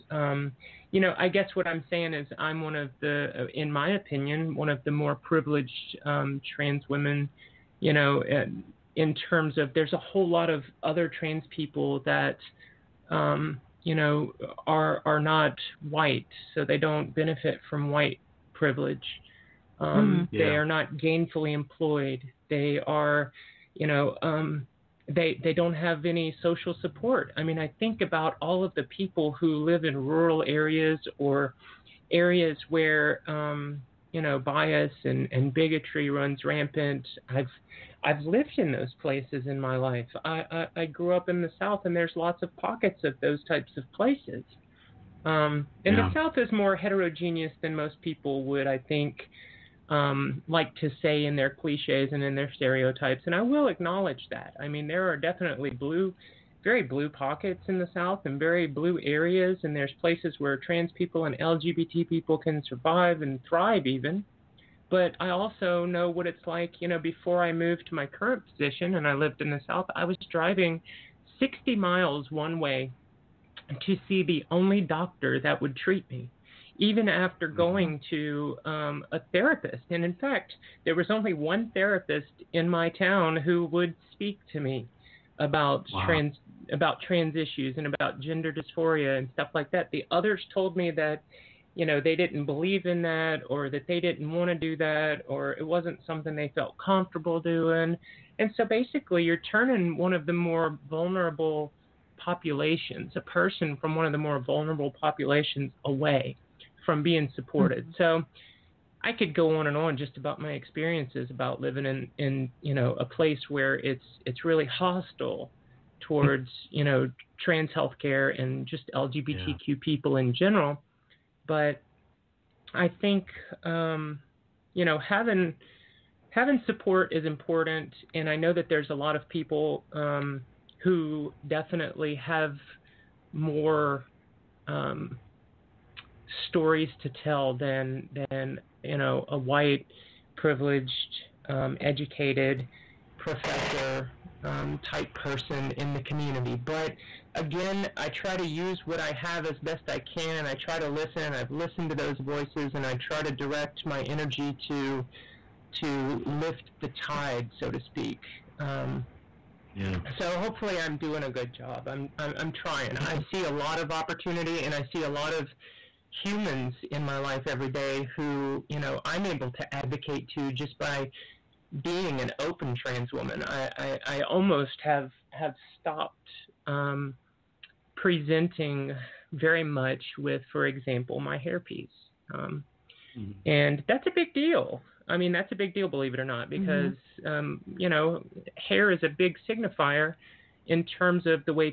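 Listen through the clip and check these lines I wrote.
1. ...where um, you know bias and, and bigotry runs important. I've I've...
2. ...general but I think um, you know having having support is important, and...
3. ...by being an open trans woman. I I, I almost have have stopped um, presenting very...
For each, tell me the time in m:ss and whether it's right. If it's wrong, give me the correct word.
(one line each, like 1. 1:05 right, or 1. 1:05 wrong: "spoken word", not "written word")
1. 0:32 wrong: "rampant", not "important"
2. 2:00 right
3. 2:50 right.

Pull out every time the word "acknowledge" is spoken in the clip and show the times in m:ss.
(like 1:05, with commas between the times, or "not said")
0:53.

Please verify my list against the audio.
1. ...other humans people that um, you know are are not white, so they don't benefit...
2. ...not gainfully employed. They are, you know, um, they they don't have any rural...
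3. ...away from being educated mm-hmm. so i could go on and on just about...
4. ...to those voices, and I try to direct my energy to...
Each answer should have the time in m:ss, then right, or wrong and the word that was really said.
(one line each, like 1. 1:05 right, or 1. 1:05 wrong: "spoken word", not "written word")
1. 0:10 wrong: "trans", not "humans"
2. 0:20 wrong: "social", not "rural"
3. 1:45 wrong: "supported", not "educated"
4. 2:31 right.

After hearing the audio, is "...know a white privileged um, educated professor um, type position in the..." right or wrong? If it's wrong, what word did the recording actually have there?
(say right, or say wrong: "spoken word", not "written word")
wrong: "person", not "position".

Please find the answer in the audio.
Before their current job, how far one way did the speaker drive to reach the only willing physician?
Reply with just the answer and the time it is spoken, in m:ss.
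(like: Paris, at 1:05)
60 miles, at 1:11.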